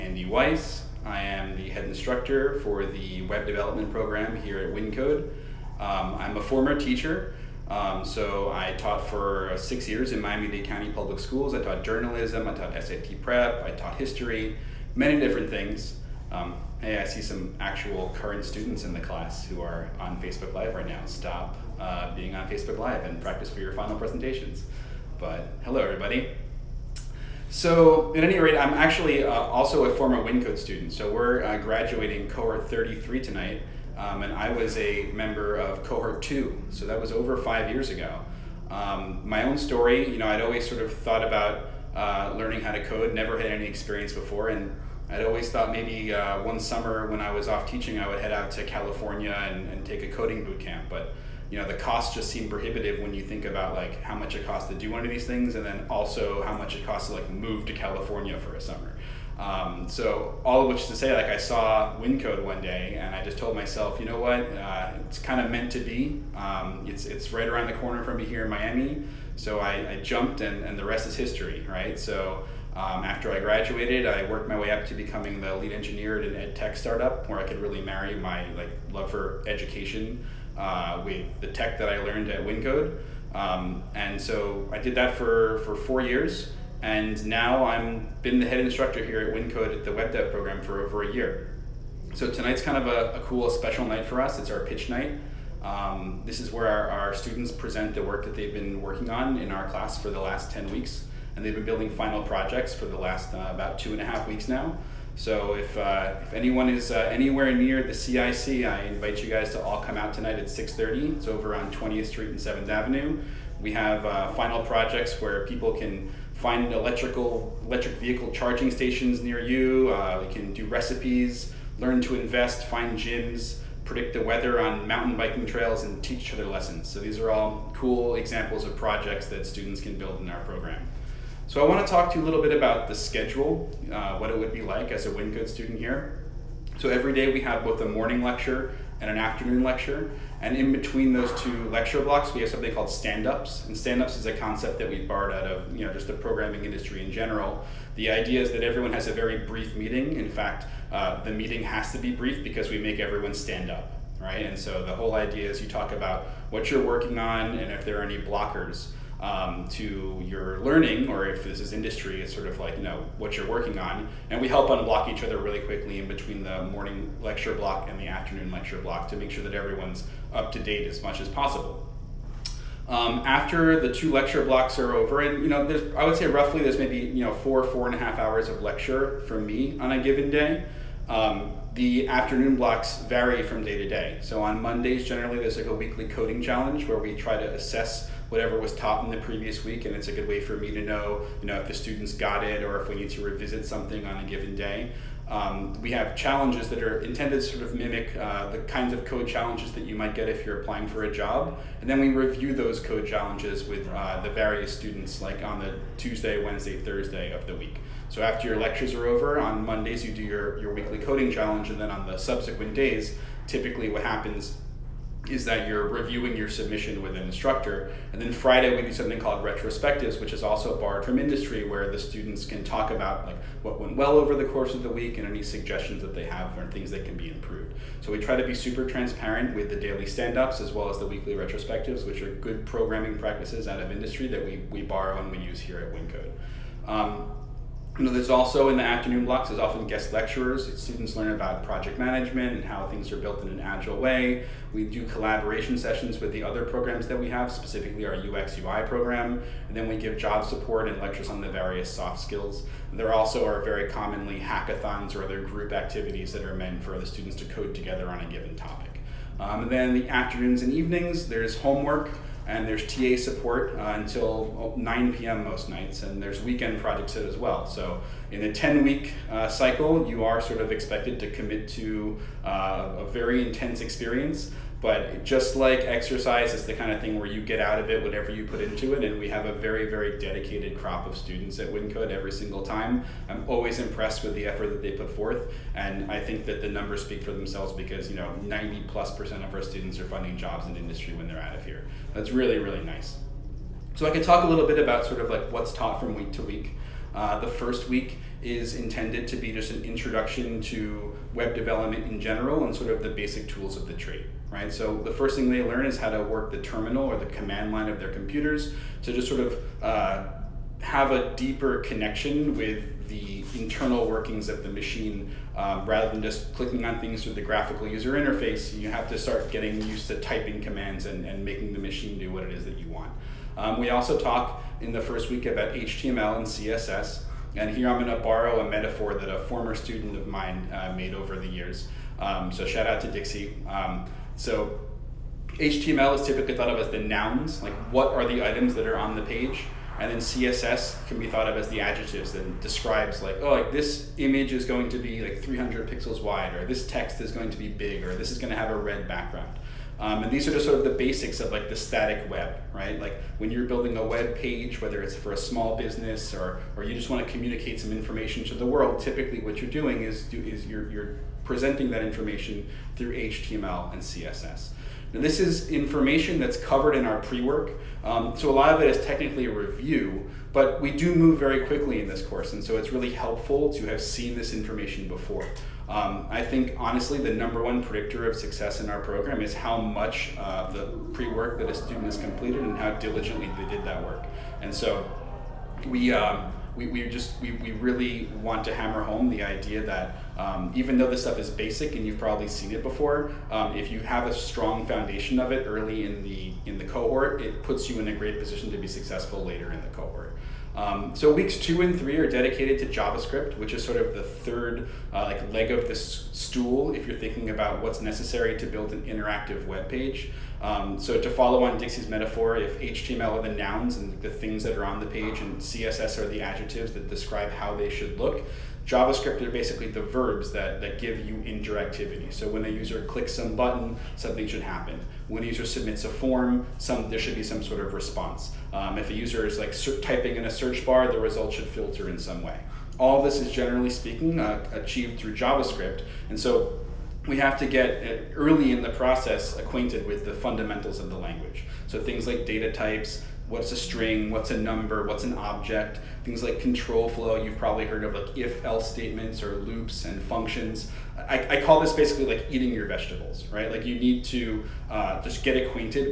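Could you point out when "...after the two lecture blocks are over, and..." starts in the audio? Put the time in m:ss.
2:53.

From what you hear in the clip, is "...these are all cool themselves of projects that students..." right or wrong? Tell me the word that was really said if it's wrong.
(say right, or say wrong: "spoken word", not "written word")
wrong: "examples", not "themselves".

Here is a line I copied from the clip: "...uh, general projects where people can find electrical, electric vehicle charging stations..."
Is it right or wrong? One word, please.
wrong.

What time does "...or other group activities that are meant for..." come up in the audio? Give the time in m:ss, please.
4:15.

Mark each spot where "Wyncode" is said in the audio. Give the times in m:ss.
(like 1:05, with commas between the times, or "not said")
0:04, 0:30, 1:02, 1:22, 1:29, 2:15, 3:55, 4:41.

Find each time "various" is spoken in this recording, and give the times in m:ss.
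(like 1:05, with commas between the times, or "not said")
3:24, 4:11.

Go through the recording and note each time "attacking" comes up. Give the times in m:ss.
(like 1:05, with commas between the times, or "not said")
not said.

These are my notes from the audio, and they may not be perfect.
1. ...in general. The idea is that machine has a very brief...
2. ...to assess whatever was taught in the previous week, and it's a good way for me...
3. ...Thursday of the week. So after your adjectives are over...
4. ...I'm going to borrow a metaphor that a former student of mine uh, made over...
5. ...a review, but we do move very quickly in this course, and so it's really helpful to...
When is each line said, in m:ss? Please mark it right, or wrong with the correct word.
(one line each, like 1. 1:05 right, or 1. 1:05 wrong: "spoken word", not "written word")
1. 2:27 wrong: "everyone", not "machine"
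2. 3:07 right
3. 3:26 wrong: "lectures", not "adjectives"
4. 5:27 right
5. 6:09 right.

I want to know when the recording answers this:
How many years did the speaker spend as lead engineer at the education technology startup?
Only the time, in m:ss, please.
1:25.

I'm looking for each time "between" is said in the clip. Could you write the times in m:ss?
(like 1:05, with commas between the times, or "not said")
2:20, 2:46.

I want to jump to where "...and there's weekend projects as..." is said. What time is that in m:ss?
4:26.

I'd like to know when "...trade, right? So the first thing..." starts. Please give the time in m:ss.
5:03.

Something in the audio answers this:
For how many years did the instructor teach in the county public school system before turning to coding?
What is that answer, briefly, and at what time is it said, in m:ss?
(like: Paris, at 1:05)
6, at 0:09.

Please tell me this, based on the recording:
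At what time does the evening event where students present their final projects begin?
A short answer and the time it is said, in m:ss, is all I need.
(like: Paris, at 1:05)
6:30, at 1:50.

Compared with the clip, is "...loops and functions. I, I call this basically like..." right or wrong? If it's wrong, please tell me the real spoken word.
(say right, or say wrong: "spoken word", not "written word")
right.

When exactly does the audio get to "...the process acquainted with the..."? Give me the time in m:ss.
7:18.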